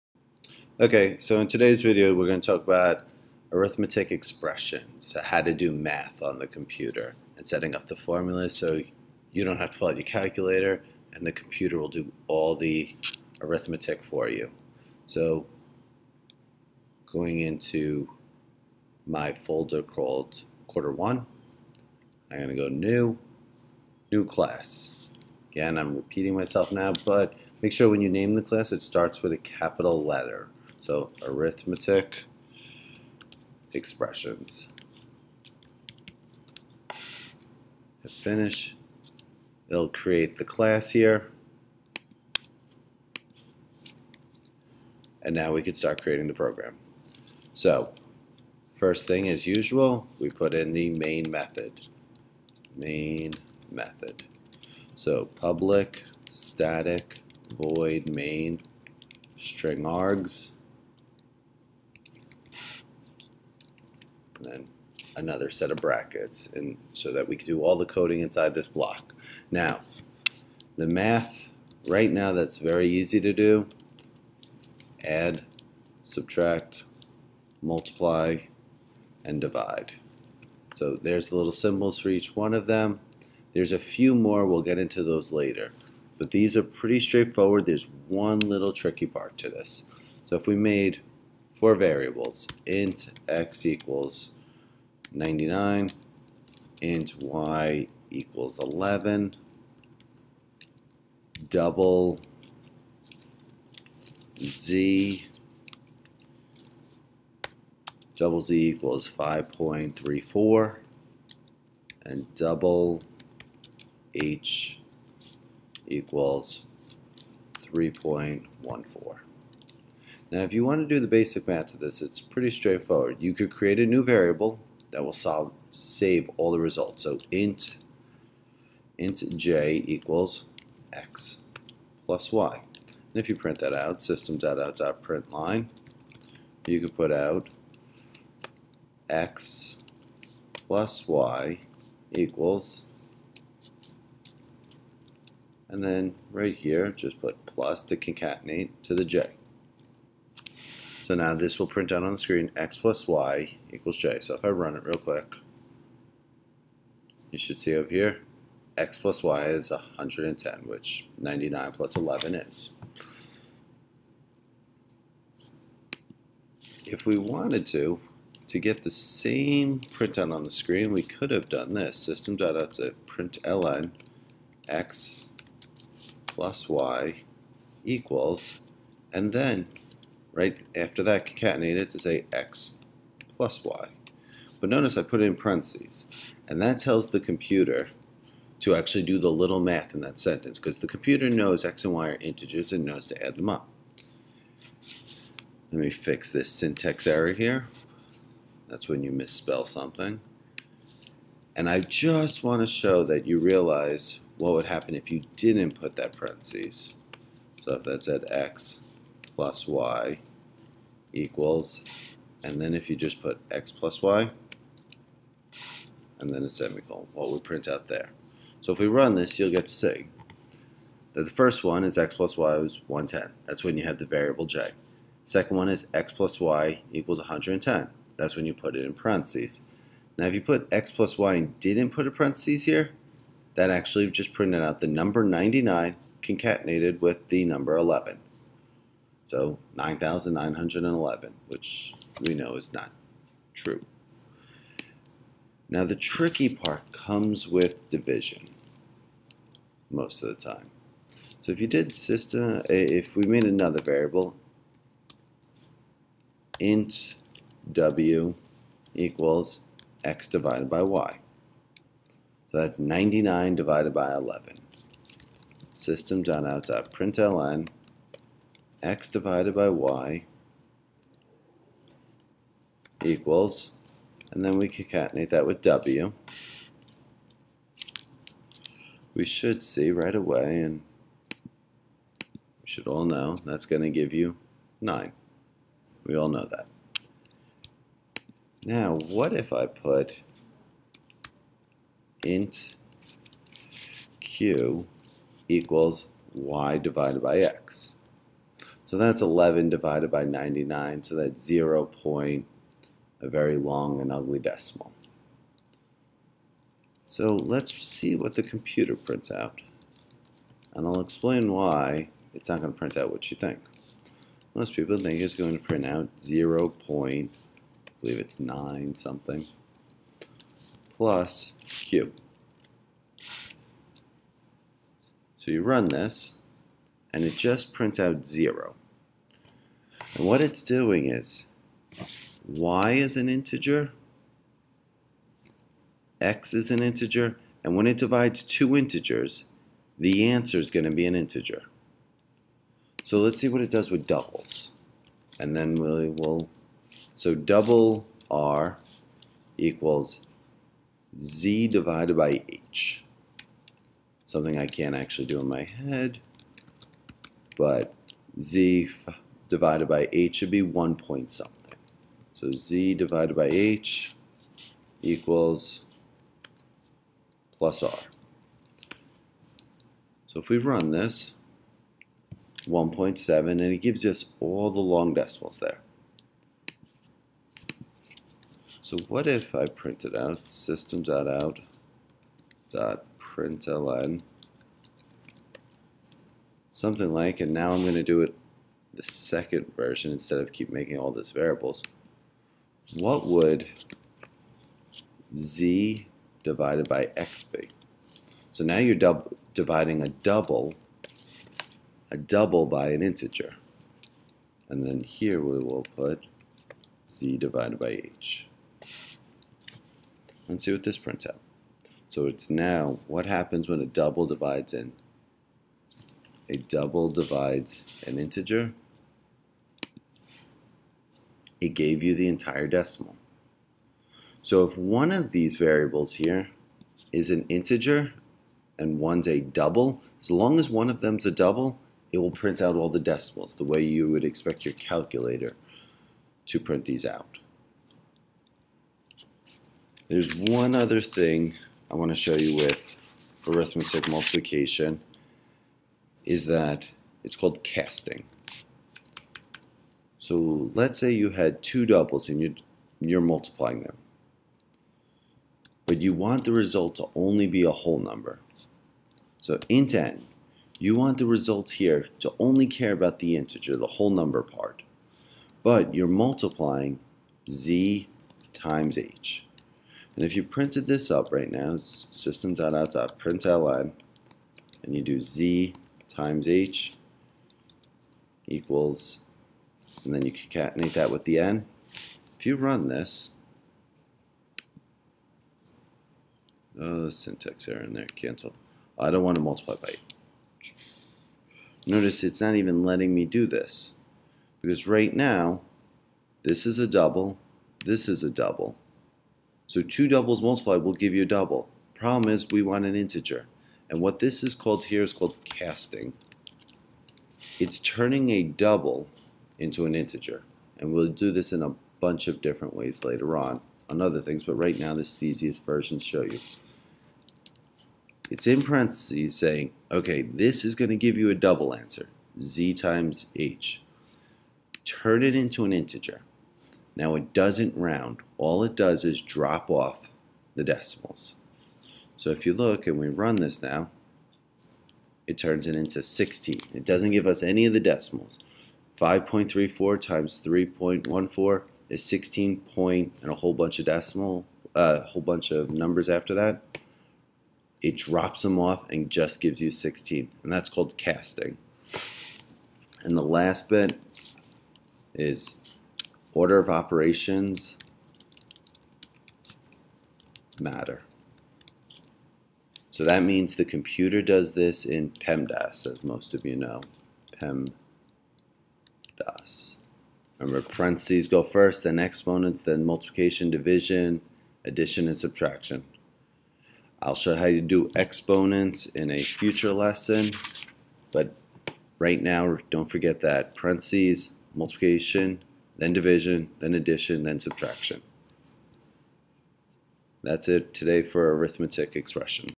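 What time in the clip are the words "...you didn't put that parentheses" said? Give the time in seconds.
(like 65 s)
205 s.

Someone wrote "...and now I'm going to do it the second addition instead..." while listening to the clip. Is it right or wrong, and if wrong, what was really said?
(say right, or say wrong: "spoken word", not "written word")
wrong: "version", not "addition".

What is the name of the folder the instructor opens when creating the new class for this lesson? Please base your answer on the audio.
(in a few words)
quarter one.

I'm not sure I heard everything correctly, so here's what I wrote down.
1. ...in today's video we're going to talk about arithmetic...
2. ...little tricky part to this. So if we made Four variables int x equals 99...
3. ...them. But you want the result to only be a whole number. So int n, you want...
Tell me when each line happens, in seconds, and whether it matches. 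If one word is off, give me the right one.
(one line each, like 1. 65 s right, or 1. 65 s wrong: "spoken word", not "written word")
1. 1 s right
2. 88 s right
3. 453 s right.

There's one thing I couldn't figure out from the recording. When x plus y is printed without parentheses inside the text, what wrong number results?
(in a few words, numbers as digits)
9,911.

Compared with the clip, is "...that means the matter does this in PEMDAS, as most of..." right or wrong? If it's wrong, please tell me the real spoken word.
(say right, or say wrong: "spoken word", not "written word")
wrong: "computer", not "matter".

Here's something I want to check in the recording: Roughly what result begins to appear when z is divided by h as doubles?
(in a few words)
1.7.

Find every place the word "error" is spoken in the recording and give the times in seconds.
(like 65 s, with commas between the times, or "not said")
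197 s, 487 s.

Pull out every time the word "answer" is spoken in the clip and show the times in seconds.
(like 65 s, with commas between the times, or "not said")
340 s, 521 s.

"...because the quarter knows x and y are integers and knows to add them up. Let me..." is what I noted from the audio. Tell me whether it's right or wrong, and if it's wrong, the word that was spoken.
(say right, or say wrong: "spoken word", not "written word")
wrong: "computer", not "quarter".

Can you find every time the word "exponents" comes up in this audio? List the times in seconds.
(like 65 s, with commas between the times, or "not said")
571 s, 577 s.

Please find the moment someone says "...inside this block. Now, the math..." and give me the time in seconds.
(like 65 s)
68 s.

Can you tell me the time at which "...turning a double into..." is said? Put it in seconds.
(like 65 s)
507 s.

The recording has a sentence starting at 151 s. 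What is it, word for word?
So now this will print out on the screen x plus y equals j.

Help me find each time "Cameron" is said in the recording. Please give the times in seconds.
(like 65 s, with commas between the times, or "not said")
not said.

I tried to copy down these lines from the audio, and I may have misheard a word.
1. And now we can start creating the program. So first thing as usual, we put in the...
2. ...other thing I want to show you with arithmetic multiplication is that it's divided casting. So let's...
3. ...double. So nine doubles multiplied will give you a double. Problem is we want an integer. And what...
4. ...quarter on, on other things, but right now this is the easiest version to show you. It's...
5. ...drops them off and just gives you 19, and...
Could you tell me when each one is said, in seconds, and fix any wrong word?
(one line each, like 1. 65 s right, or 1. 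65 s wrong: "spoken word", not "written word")
1. 45 s right
2. 440 s wrong: "called", not "divided"
3. 498 s wrong: "two", not "nine"
4. 513 s wrong: "later", not "quarter"
5. 547 s wrong: "16", not "19".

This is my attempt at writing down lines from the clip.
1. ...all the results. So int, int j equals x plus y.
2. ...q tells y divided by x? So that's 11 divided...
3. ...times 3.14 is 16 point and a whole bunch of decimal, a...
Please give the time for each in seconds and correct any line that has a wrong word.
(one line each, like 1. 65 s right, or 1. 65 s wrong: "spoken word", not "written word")
1. 126 s right
2. 294 s wrong: "equals", not "tells"
3. 539 s right.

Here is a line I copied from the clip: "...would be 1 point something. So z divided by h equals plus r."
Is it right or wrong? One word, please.
right.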